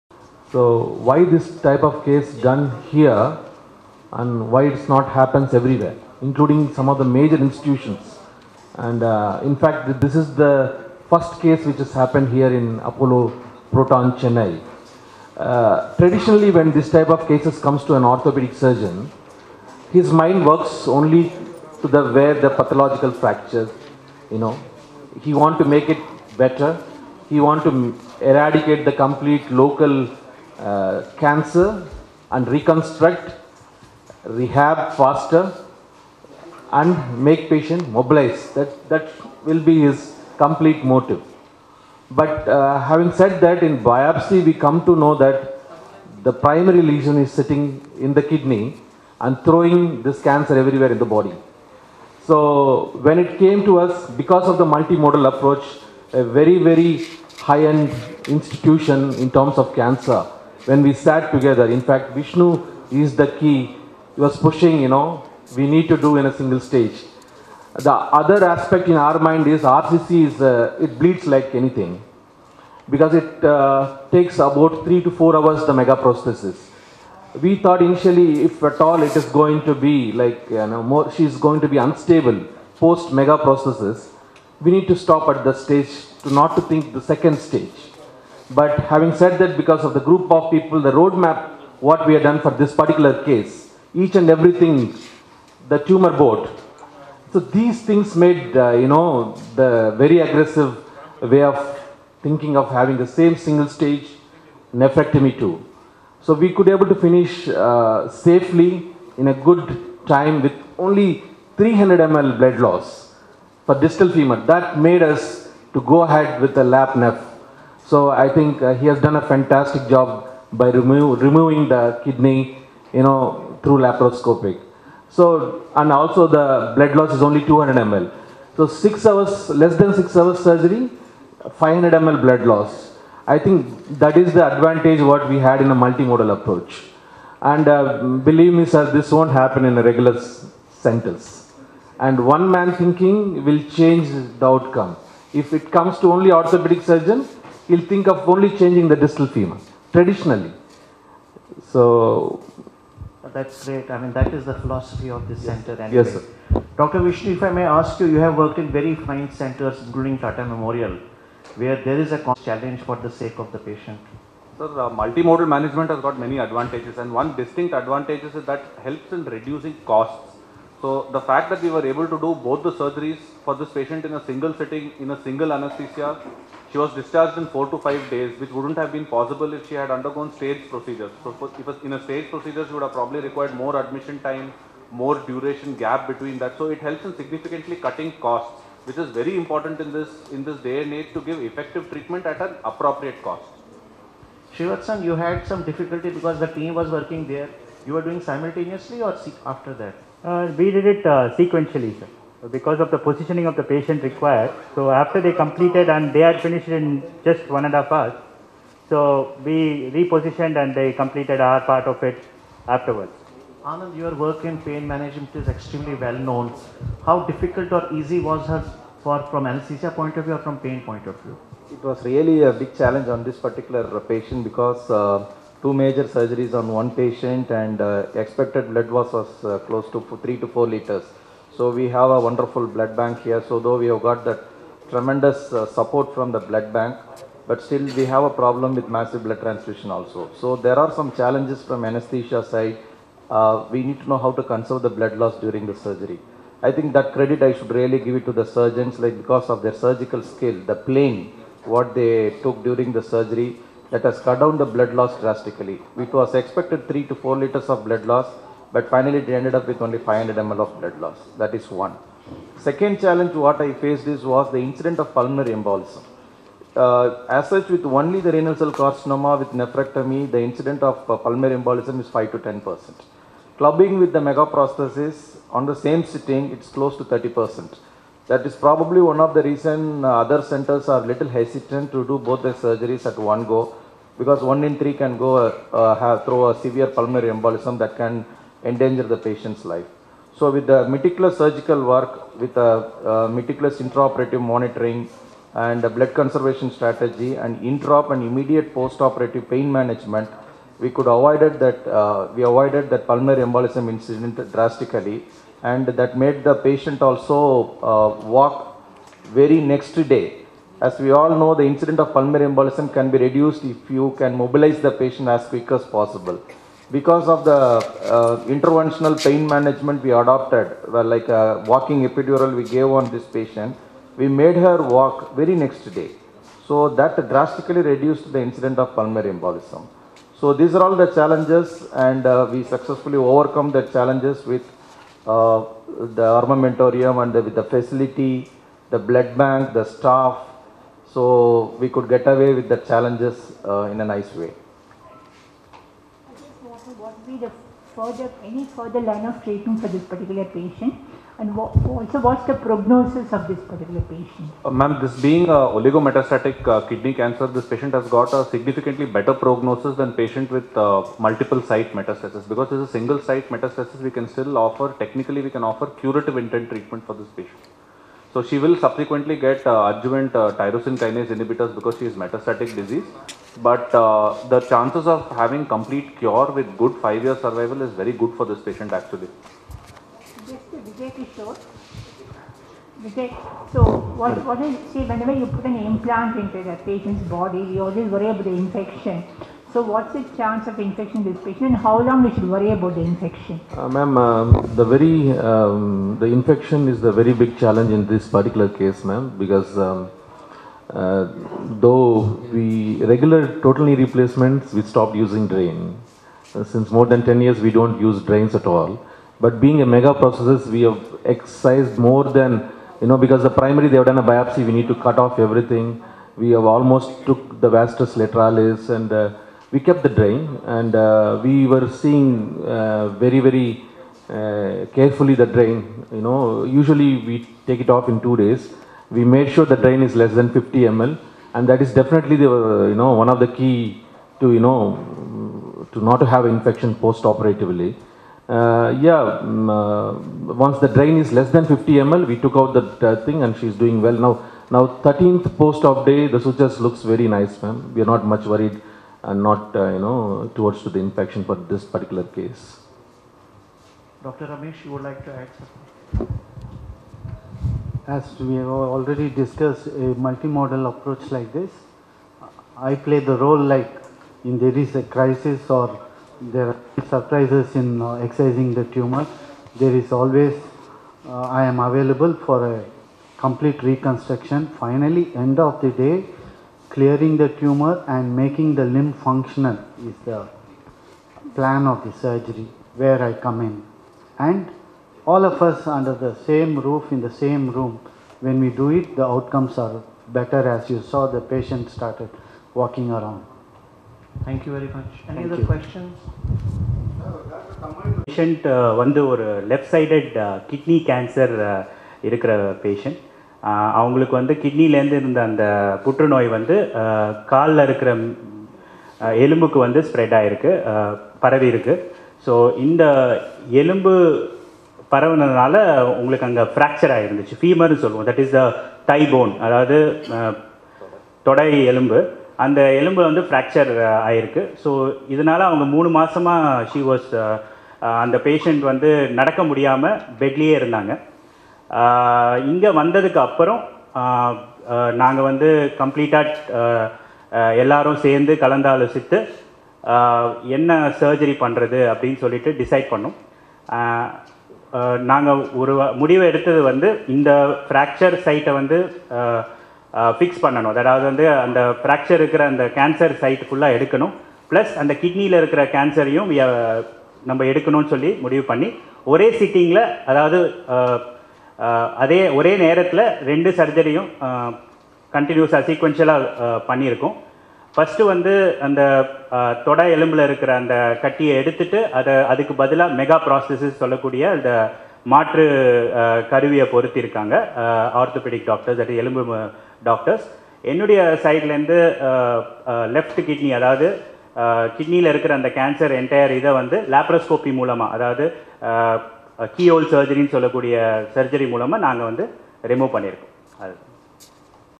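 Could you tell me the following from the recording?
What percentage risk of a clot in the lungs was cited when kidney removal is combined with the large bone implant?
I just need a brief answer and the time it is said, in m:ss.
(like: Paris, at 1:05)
30 percent, at 4:37.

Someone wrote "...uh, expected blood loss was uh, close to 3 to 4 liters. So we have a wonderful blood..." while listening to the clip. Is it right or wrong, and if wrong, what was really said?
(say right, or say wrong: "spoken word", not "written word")
right.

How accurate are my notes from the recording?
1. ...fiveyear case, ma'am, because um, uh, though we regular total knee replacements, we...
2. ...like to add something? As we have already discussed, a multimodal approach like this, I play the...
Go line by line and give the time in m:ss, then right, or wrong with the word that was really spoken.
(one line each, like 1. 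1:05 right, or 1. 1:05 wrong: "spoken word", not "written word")
1. 6:38 wrong: "particular", not "fiveyear"
2. 7:35 right.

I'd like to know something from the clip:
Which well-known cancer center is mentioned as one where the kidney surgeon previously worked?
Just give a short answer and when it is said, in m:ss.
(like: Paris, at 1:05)
Tata Memorial, at 2:40.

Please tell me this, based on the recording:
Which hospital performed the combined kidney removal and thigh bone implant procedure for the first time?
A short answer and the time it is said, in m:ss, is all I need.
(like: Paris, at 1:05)
Apollo Proton Chennai, at 0:12.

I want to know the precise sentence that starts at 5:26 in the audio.
So that drastically reduced the incident of pulmonary embolism.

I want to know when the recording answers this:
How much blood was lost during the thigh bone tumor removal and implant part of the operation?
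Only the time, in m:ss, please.
1:51.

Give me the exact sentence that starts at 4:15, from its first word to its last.
It was expected 3 to 4 liters of blood loss but finally, it ended up with only 500 ml of blood loss.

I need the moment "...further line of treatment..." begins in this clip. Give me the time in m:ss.
5:48.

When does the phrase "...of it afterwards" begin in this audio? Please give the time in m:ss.
3:31.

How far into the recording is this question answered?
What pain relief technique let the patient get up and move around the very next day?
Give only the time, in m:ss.
5:21.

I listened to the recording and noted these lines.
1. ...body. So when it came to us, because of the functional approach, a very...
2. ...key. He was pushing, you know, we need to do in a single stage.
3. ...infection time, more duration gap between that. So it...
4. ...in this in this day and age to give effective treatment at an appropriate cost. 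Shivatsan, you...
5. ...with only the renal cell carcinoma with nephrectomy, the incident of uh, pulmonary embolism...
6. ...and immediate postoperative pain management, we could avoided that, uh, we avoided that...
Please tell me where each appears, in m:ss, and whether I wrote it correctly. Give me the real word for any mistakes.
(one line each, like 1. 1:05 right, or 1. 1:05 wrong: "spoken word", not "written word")
1. 0:51 wrong: "multimodal", not "functional"
2. 1:03 right
3. 3:03 wrong: "admission", not "infection"
4. 3:09 right
5. 4:27 right
6. 4:58 right.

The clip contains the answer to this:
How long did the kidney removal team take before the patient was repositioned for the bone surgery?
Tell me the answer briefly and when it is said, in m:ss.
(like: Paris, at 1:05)
one and a half hours, at 3:27.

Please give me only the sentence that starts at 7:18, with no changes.
Uh, yeah, um, once the drain is less than 50 ml, we took out the uh, thing and she's doing well now.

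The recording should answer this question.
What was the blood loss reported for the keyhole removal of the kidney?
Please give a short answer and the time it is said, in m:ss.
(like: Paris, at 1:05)
200 ml, at 2:07.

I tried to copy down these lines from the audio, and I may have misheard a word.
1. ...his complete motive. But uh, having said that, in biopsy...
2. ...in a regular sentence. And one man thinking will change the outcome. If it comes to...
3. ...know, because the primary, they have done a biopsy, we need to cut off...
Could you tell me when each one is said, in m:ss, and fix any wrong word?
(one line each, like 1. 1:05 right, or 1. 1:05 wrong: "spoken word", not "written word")
1. 0:39 right
2. 2:19 right
3. 6:53 right.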